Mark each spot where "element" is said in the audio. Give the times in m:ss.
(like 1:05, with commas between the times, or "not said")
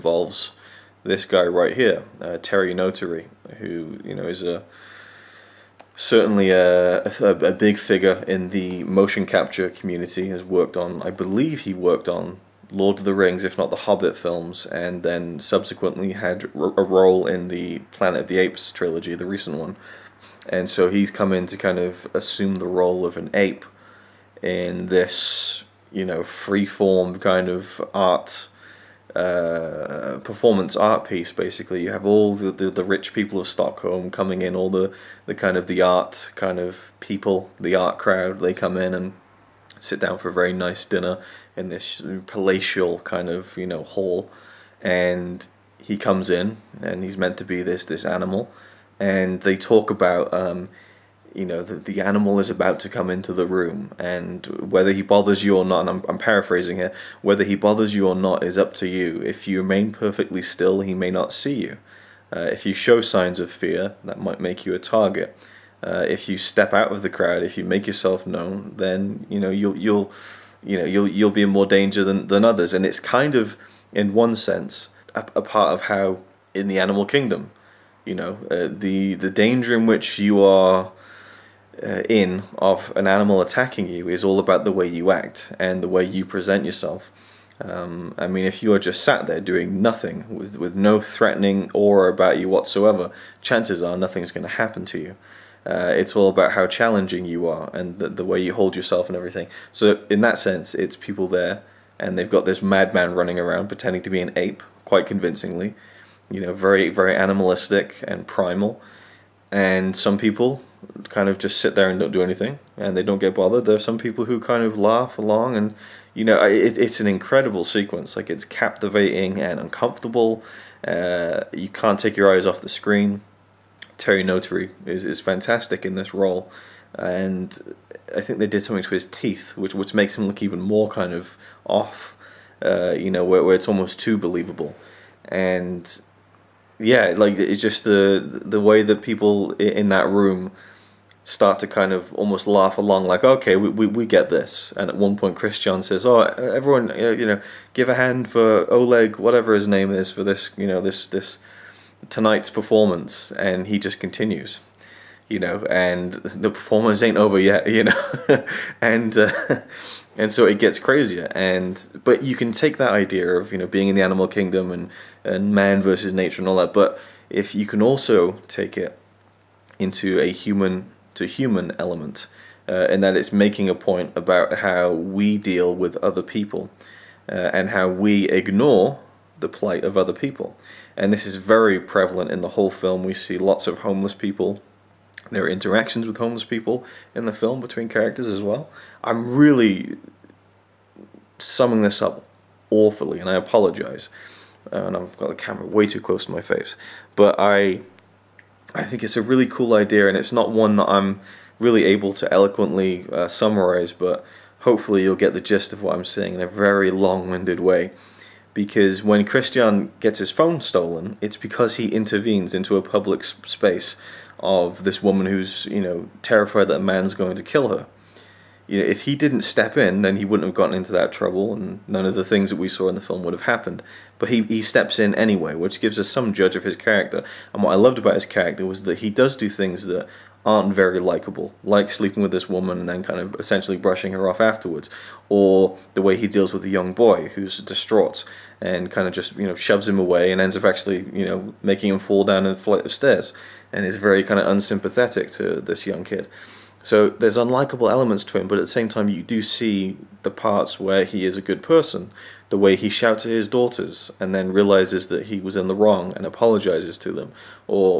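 2:51, 4:07.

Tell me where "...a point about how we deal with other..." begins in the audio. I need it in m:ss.
2:53.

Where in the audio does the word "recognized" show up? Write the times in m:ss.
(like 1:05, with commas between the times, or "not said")
not said.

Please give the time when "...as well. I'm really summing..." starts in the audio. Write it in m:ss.
3:08.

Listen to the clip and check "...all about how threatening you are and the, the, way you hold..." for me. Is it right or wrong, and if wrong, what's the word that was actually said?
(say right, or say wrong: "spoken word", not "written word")
wrong: "challenging", not "threatening".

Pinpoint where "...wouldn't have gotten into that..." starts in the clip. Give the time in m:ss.
3:40.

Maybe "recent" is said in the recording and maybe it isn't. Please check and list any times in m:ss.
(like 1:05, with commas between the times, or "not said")
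0:19.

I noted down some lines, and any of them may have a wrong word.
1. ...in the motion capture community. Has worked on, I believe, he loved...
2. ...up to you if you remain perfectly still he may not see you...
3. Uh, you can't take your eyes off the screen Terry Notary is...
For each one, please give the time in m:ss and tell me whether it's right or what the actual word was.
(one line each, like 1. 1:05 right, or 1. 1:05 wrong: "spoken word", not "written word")
1. 0:08 wrong: "worked", not "loved"
2. 0:58 right
3. 2:00 right.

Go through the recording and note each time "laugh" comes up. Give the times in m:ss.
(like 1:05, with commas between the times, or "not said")
1:54, 2:22.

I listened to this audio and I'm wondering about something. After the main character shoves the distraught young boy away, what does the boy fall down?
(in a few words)
A flight of stairs.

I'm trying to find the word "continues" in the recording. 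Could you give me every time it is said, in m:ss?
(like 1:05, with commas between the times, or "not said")
2:33.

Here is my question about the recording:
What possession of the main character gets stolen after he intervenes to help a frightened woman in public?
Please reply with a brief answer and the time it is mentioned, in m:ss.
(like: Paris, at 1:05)
His phone, at 3:30.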